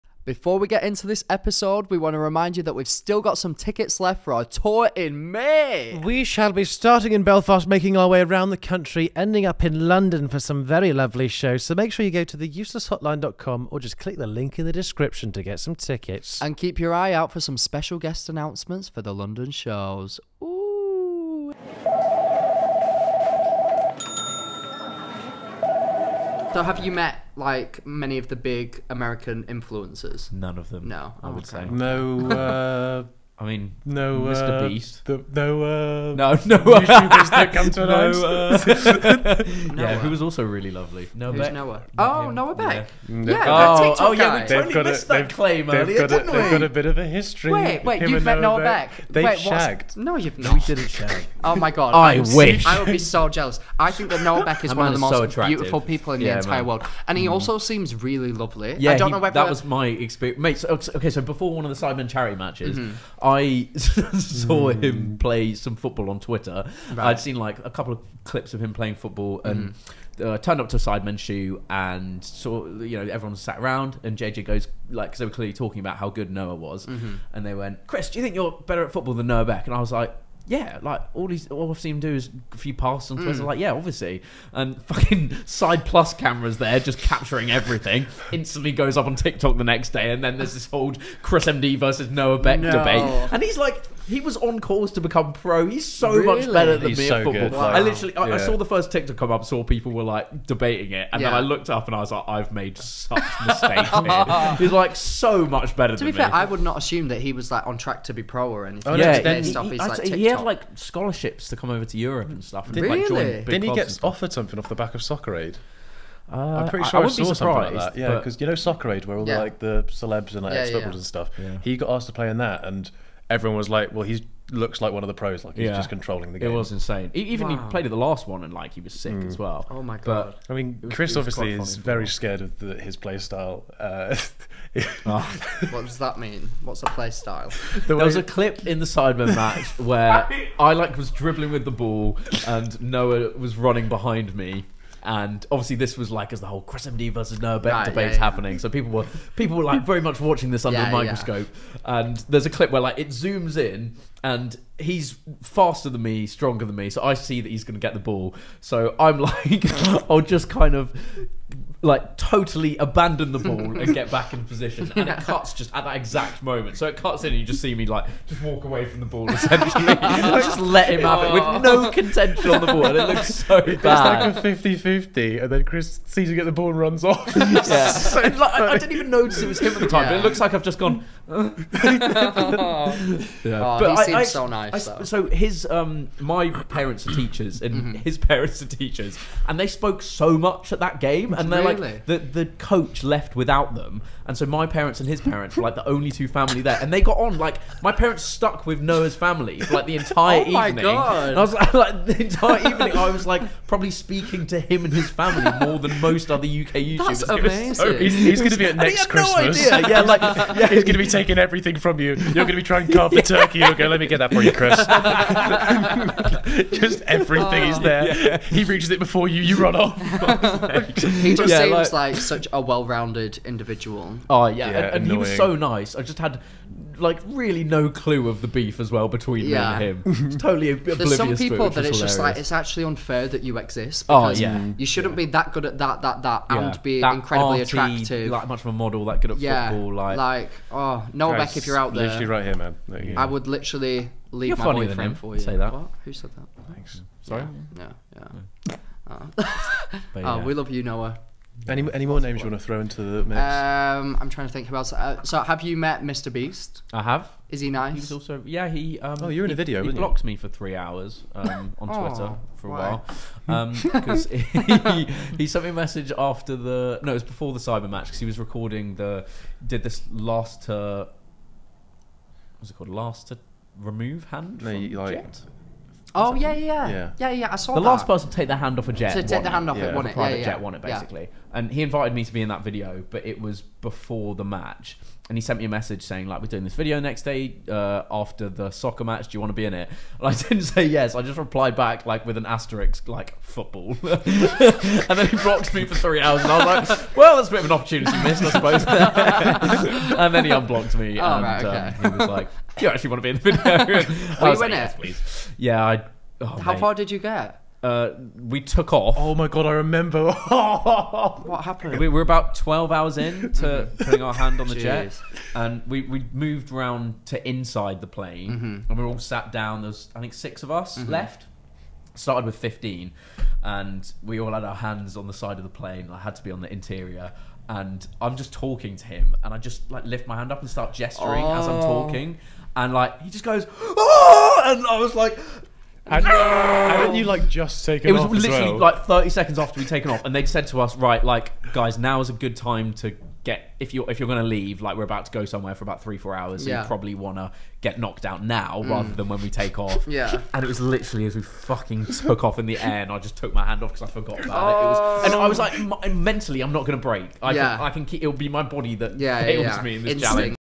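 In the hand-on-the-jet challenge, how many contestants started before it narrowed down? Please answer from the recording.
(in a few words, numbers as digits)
15.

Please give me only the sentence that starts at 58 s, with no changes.
Yeah, don't know whether that was my experience, mate.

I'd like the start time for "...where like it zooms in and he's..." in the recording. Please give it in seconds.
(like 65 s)
152 s.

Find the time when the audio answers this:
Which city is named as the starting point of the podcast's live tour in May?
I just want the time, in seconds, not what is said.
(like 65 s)
7 s.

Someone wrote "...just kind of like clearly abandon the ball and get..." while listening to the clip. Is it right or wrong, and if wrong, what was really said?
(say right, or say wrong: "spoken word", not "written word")
wrong: "totally", not "clearly".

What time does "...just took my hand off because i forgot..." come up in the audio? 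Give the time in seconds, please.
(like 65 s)
353 s.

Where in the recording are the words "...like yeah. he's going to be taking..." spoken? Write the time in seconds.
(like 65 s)
210 s.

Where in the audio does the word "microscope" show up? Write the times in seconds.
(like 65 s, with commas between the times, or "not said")
150 s.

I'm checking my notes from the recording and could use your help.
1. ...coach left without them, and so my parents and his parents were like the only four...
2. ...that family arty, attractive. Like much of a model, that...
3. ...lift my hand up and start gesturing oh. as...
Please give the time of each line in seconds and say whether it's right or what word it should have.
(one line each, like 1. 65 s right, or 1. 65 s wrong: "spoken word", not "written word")
1. 192 s wrong: "two", not "four"
2. 237 s wrong: "incredibly", not "family"
3. 330 s right.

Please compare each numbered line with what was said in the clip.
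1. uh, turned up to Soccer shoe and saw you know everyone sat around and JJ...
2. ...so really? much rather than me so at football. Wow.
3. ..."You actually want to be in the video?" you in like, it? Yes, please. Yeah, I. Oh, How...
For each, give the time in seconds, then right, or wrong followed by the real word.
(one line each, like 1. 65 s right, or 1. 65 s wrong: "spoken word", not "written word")
1. 70 s wrong: "Sidemen", not "Soccer"
2. 95 s wrong: "better", not "rather"
3. 302 s right.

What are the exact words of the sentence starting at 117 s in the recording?
Yeah, because you know Soccer Aid, where all yeah.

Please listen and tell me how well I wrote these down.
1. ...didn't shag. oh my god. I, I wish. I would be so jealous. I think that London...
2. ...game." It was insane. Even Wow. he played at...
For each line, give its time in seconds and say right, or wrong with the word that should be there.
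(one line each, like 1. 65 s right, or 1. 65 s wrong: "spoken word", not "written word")
1. 50 s wrong: "Noah", not "London"
2. 126 s right.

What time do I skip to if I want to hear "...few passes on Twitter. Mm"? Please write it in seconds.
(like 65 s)
82 s.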